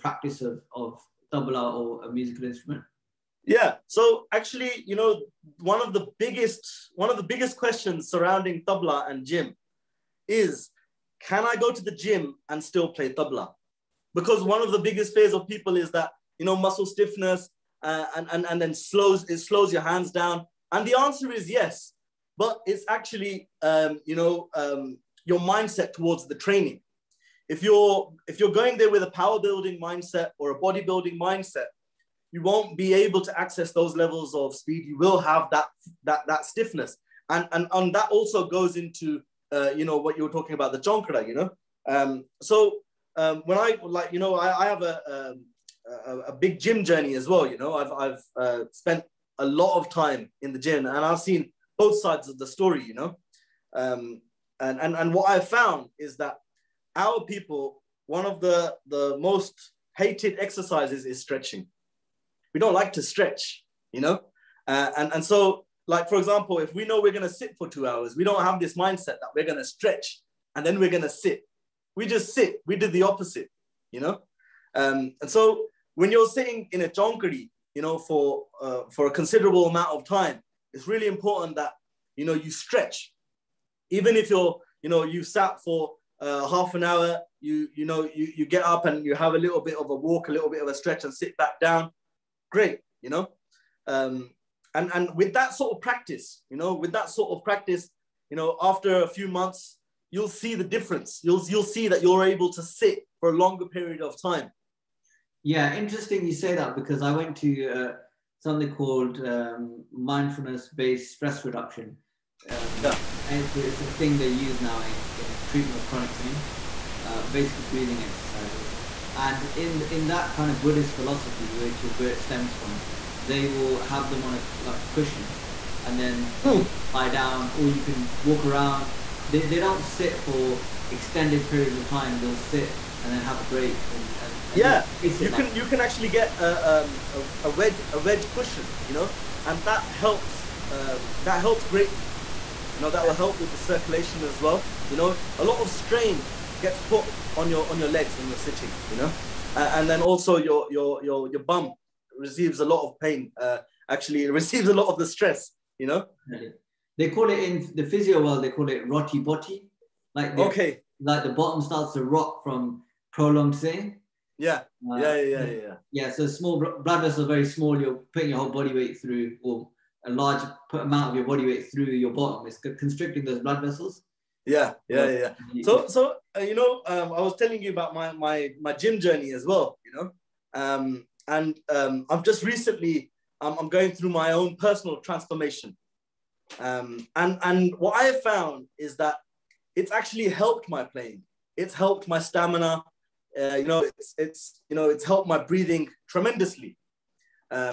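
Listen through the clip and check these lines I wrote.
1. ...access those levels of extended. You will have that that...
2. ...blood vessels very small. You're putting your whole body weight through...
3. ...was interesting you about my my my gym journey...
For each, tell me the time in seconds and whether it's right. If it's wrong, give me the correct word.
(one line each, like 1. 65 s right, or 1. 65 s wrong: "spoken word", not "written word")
1. 33 s wrong: "speed", not "extended"
2. 166 s right
3. 177 s wrong: "telling", not "interesting".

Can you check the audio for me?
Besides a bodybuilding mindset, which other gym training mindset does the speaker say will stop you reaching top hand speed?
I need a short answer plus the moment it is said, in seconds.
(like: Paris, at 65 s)
Power building, at 29 s.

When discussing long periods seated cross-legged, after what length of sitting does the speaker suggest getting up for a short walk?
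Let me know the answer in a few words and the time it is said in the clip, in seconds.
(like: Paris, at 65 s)
Half an hour, at 86 s.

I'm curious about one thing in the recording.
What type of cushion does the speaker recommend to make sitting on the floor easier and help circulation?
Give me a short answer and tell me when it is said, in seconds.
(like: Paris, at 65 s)
Wedge cushion, at 137 s.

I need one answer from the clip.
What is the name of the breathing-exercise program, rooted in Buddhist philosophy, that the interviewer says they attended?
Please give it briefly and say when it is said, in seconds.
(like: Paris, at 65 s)
Mindfulness-based stress reduction, at 109 s.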